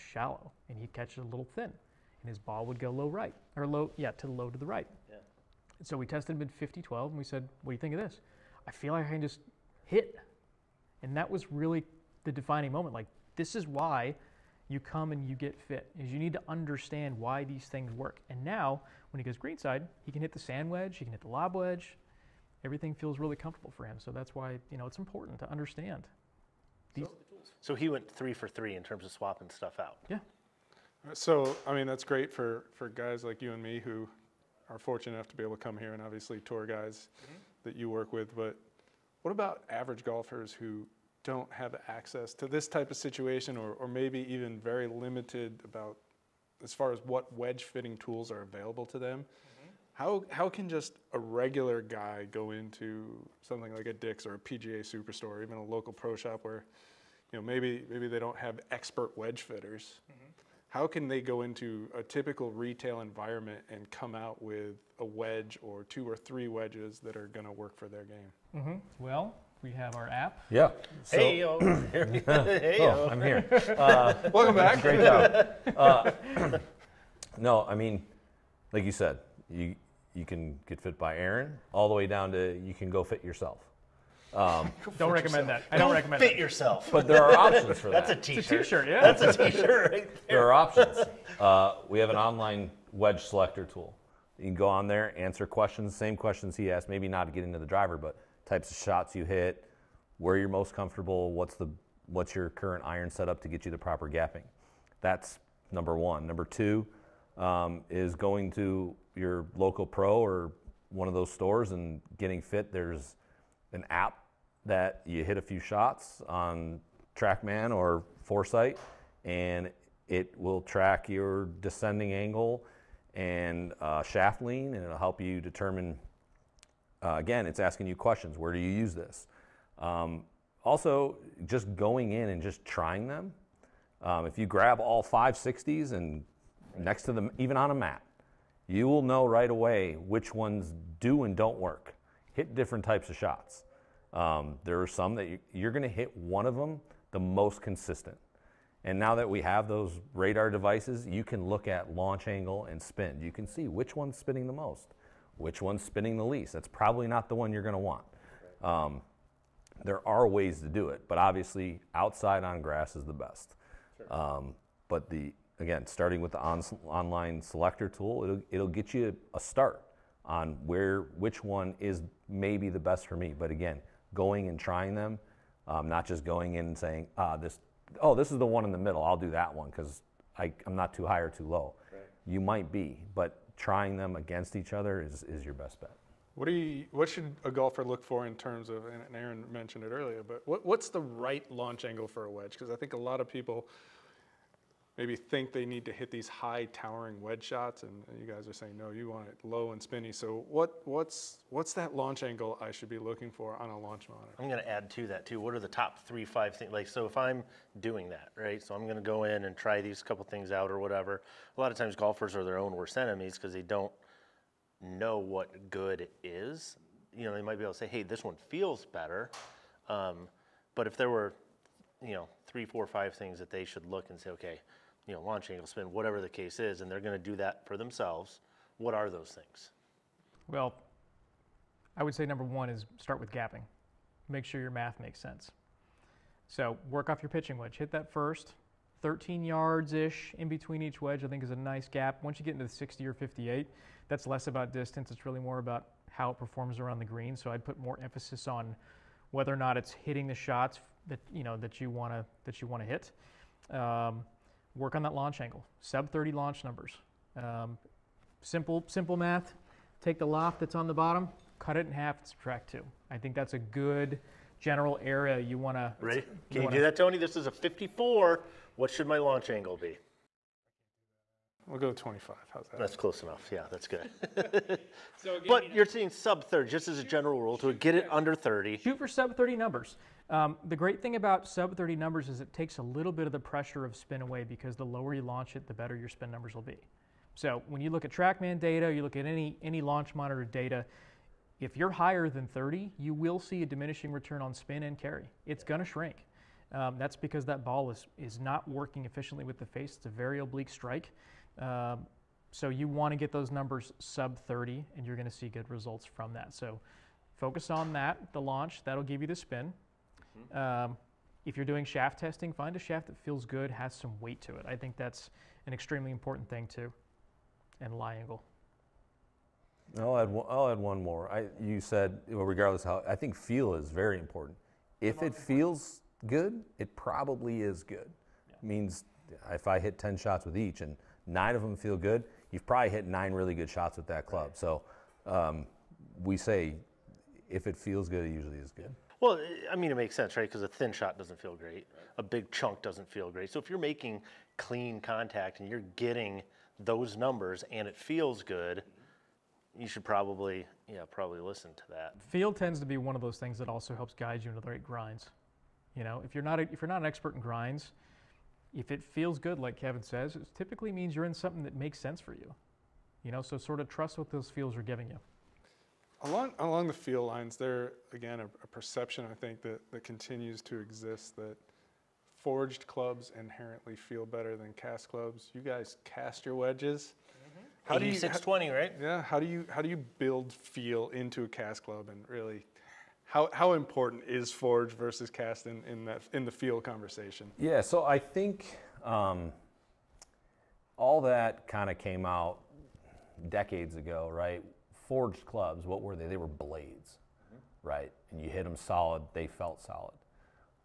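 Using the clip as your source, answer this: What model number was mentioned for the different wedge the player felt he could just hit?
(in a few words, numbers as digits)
50 12.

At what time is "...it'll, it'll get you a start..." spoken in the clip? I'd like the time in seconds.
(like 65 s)
168 s.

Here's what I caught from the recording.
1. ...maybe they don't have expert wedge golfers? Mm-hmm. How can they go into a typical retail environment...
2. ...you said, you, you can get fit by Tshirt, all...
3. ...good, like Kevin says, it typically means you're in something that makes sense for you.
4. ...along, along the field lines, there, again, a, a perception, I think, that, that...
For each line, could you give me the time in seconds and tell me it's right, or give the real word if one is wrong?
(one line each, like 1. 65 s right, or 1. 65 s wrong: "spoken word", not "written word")
1. 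57 s wrong: "fitters", not "golfers"
2. 78 s wrong: "Aaron", not "Tshirt"
3. 359 s right
4. 366 s right.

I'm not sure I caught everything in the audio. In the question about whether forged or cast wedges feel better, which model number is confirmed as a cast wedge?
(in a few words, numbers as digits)
620.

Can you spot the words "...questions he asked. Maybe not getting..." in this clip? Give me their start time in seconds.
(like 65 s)
96 s.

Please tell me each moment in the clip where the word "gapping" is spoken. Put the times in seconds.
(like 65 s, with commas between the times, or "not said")
104 s, 233 s.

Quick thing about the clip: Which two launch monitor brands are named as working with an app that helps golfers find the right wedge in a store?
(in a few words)
TrackMan or Foresight.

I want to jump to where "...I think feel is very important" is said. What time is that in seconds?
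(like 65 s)
323 s.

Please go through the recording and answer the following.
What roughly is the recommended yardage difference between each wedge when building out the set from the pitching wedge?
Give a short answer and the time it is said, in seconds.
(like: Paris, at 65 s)
13 yards, at 239 s.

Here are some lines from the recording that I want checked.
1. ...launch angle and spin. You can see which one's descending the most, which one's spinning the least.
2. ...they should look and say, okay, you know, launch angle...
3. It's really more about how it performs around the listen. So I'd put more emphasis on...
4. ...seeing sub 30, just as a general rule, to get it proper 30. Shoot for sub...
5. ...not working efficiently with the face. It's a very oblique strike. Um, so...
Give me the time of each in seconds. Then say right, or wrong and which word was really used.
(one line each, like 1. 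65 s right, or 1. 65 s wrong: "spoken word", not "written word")
1. 151 s wrong: "spinning", not "descending"
2. 223 s right
3. 245 s wrong: "green", not "listen"
4. 275 s wrong: "under", not "proper"
5. 298 s right.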